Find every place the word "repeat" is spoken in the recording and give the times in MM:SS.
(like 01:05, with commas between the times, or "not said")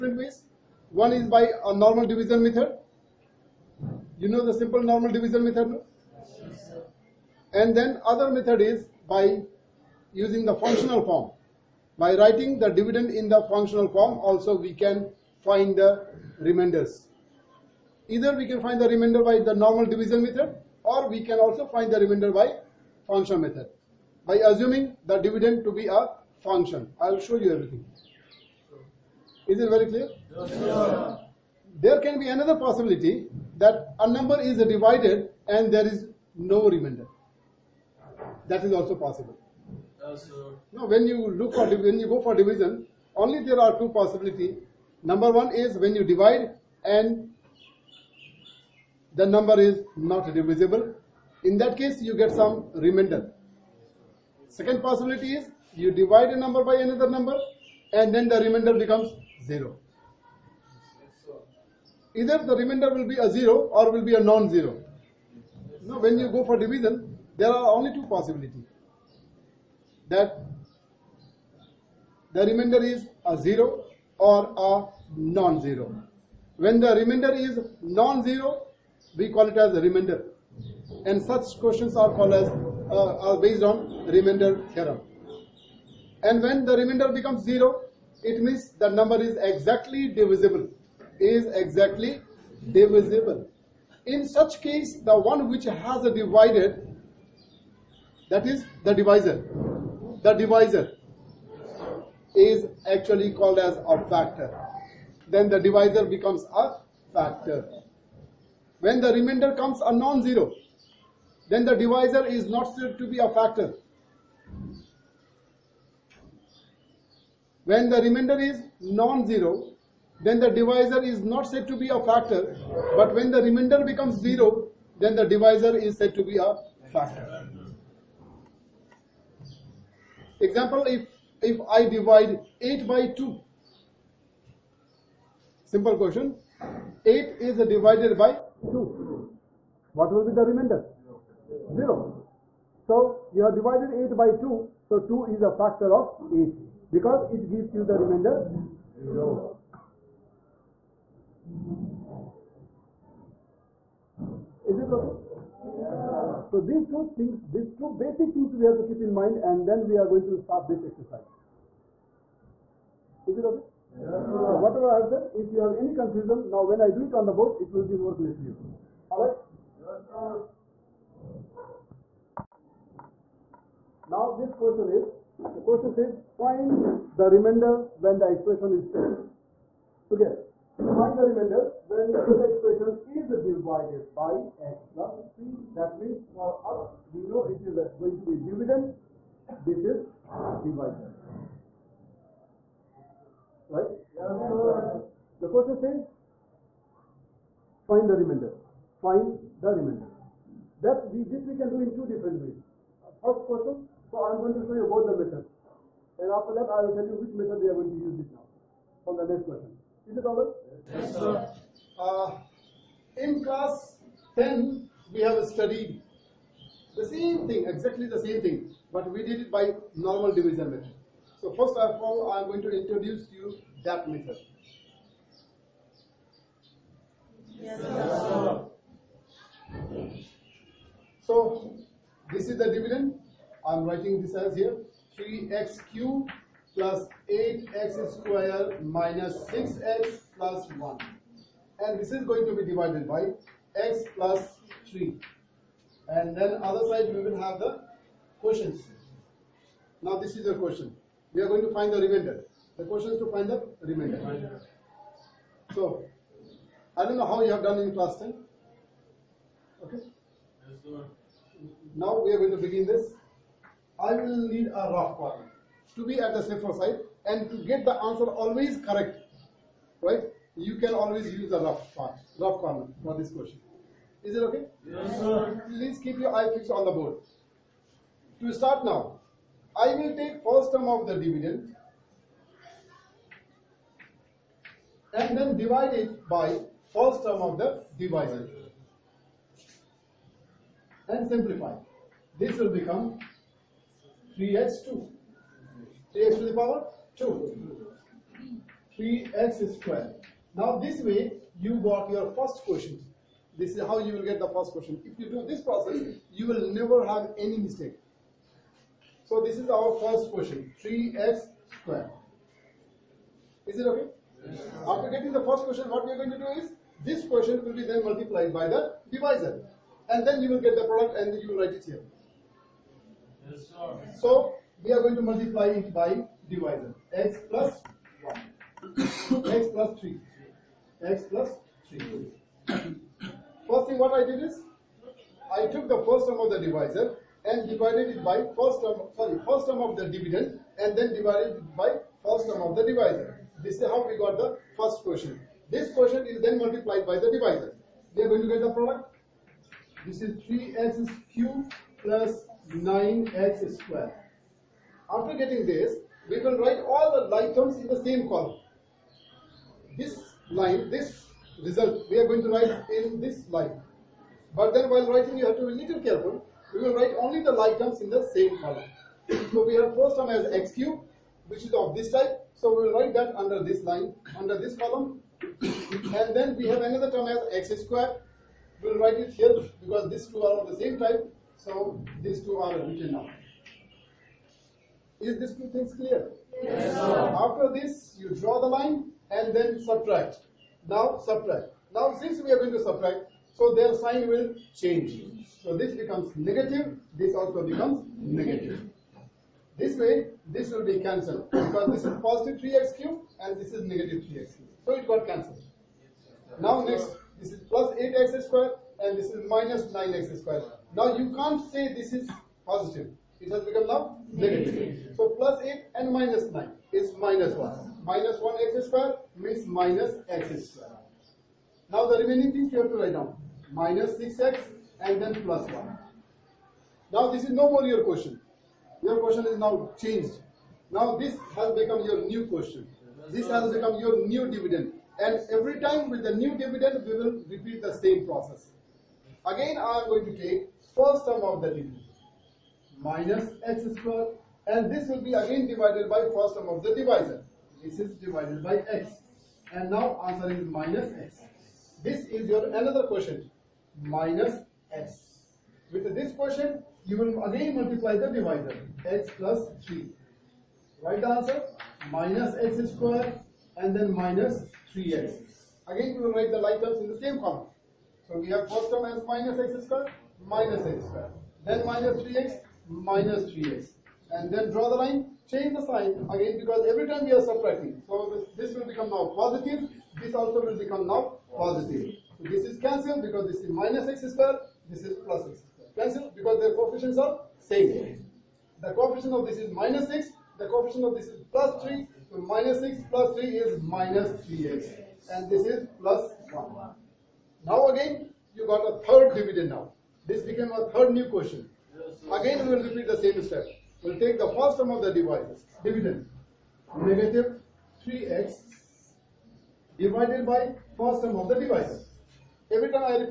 07:17, 08:22.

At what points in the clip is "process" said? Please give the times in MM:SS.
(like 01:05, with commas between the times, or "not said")
05:05, 07:18.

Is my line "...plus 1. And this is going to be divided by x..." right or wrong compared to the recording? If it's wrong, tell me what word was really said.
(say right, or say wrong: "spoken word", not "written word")
right.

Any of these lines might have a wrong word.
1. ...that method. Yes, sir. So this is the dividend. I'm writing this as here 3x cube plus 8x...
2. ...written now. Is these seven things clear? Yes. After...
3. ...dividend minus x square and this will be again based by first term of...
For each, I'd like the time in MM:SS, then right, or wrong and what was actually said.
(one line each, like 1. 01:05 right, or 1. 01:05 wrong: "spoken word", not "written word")
1. 03:43 right
2. 06:22 wrong: "two", not "seven"
3. 07:21 wrong: "divided", not "based".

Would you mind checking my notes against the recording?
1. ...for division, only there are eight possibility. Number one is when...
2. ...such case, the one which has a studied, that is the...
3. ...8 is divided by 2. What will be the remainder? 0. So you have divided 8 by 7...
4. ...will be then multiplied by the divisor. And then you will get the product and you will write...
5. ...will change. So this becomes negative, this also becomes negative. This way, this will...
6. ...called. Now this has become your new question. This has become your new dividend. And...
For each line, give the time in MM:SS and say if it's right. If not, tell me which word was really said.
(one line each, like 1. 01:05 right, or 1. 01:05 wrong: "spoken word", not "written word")
1. 00:42 wrong: "two", not "eight"
2. 01:34 wrong: "divided", not "studied"
3. 02:17 wrong: "2", not "7"
4. 05:17 right
5. 06:34 right
6. 07:09 wrong: "changed", not "called".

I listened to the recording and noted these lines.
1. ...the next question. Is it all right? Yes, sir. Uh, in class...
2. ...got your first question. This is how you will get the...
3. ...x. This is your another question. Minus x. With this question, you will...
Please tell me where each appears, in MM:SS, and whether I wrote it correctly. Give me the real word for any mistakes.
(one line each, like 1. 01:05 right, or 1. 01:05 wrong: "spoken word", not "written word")
1. 03:29 right
2. 05:01 right
3. 07:31 right.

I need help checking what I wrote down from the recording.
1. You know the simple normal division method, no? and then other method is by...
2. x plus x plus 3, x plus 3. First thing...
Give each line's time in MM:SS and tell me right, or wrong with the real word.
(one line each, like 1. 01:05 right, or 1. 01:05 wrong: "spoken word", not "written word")
1. 00:04 right
2. 05:27 right.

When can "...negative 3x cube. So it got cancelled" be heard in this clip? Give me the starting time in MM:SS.
06:43.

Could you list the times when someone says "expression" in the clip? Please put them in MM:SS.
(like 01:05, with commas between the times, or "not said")
02:58, 03:02.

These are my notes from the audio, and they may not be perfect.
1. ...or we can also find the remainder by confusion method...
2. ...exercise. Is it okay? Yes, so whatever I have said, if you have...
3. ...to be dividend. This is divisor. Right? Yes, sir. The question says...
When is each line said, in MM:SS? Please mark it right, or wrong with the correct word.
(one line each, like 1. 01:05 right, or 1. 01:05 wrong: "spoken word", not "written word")
1. 00:20 wrong: "function", not "confusion"
2. 02:40 right
3. 03:08 right.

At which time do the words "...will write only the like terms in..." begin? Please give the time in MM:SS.
06:06.